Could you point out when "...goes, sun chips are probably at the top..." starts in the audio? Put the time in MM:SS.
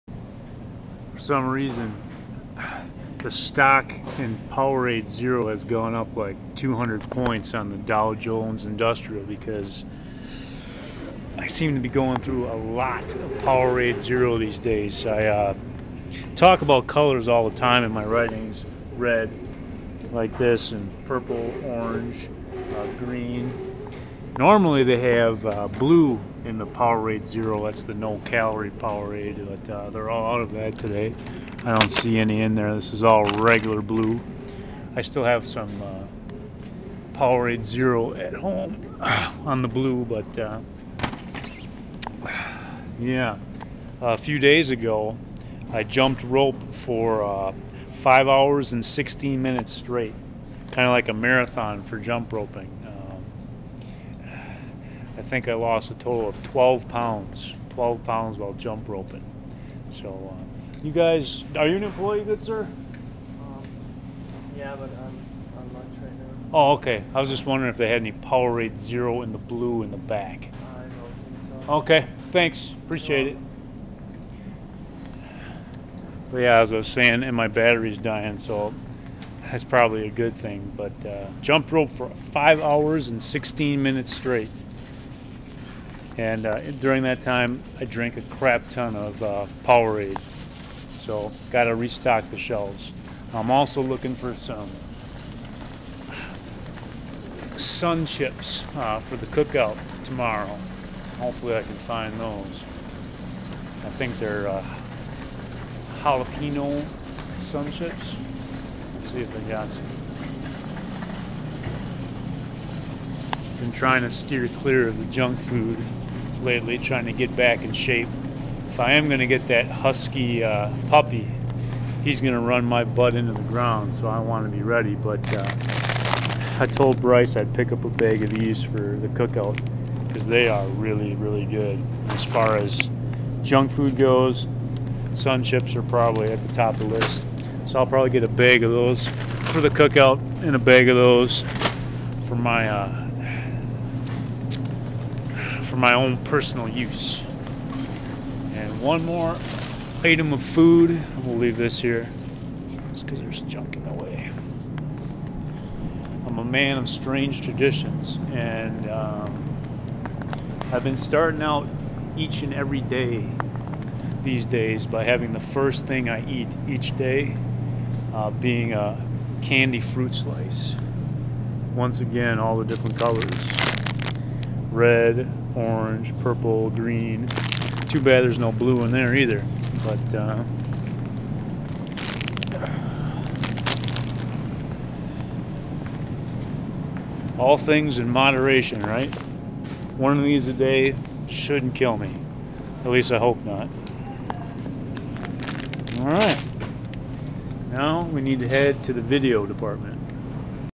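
02:13.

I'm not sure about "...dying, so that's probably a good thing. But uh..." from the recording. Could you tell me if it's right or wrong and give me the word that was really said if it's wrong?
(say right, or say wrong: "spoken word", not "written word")
right.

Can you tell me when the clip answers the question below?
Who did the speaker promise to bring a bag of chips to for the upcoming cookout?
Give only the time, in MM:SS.
02:06.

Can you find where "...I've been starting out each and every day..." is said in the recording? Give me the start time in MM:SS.
02:40.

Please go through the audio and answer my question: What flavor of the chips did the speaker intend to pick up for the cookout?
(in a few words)
jalapeno.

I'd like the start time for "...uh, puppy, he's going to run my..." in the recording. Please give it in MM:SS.
02:00.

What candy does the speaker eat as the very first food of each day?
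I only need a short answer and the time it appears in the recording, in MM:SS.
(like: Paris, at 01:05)
candy fruit slice, at 02:49.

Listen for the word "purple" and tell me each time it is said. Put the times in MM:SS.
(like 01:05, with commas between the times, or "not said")
00:21, 02:56.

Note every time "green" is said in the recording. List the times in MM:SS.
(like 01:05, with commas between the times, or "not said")
00:22, 02:56.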